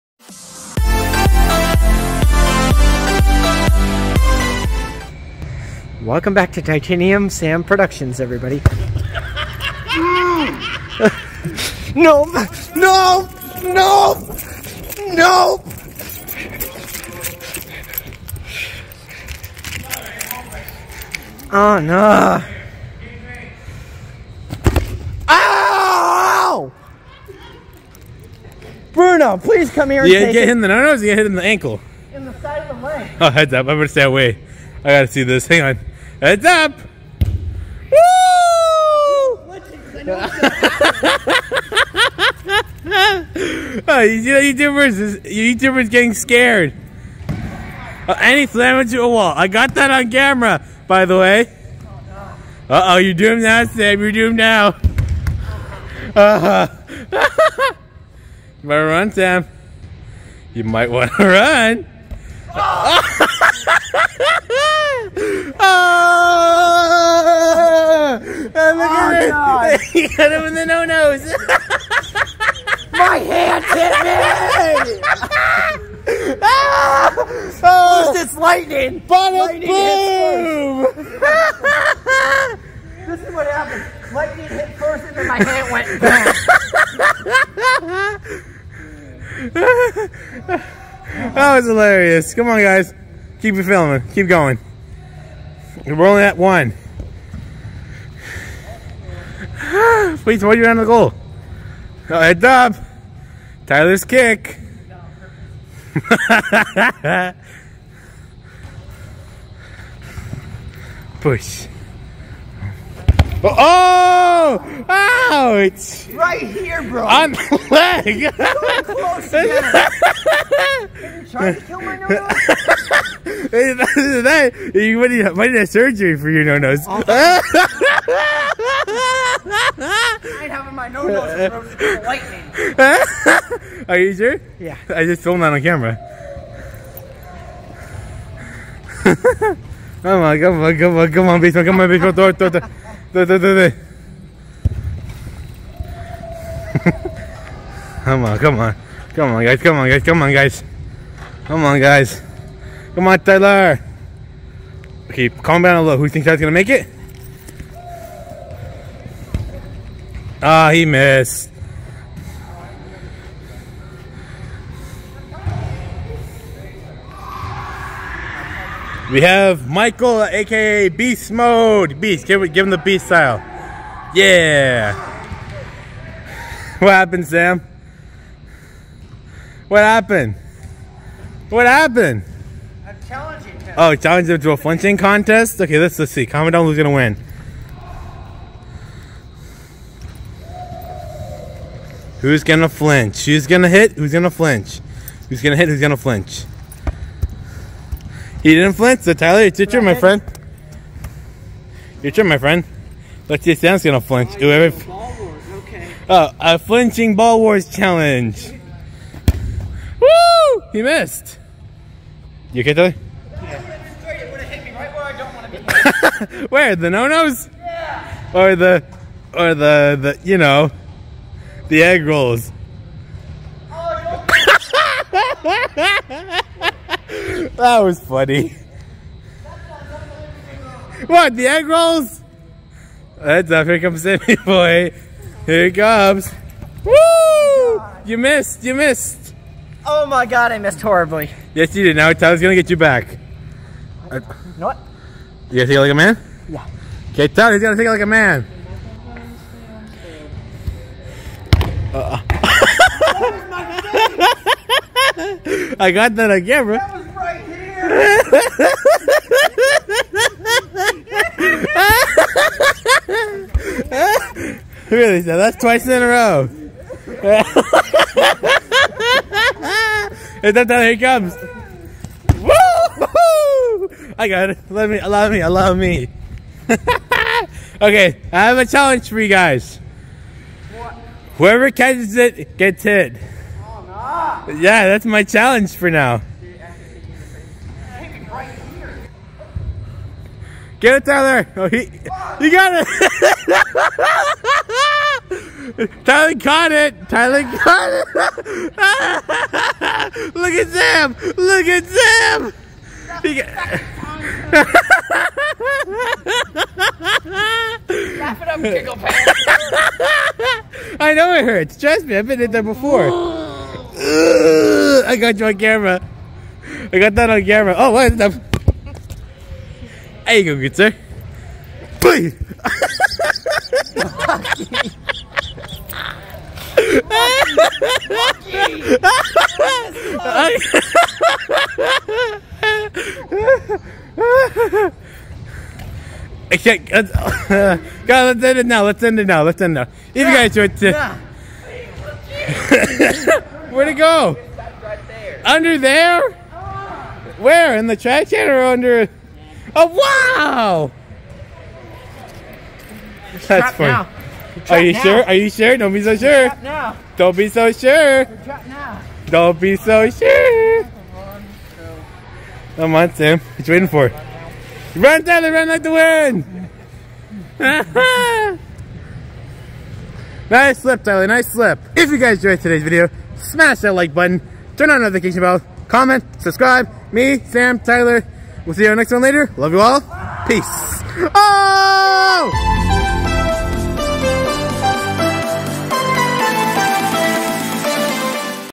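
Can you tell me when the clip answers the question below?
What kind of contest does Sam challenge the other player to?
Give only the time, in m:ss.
3:04.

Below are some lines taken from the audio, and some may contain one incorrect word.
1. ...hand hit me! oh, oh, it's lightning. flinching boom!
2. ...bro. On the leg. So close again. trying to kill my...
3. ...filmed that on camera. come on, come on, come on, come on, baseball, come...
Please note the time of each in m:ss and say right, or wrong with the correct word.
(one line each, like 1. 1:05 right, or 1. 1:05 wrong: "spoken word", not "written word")
1. 1:13 wrong: "lightning", not "flinching"
2. 1:56 right
3. 2:15 right.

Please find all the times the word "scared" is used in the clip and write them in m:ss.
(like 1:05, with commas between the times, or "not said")
0:46.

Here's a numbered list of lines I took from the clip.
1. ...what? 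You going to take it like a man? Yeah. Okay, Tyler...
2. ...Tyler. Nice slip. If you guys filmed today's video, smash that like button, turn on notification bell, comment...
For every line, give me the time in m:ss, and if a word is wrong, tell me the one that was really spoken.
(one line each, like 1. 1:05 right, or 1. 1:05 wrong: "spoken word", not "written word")
1. 4:04 right
2. 6:11 wrong: "enjoyed", not "filmed".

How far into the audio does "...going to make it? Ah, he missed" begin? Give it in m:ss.
2:36.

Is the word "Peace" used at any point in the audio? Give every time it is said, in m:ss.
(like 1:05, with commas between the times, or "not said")
6:20.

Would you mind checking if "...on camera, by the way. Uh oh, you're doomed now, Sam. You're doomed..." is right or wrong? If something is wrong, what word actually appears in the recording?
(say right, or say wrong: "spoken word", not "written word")
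right.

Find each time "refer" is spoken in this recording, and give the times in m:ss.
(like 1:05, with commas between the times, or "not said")
not said.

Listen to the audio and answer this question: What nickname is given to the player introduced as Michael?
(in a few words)
Beast Mode.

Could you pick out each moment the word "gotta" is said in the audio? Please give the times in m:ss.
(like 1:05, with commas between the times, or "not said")
0:34.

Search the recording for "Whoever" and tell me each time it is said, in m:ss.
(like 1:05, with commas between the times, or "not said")
3:24, 4:41.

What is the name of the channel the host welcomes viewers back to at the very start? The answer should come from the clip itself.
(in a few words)
Titanium Sam Productions.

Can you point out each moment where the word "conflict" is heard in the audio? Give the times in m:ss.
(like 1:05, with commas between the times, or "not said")
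not said.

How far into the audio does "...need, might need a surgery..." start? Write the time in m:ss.
2:05.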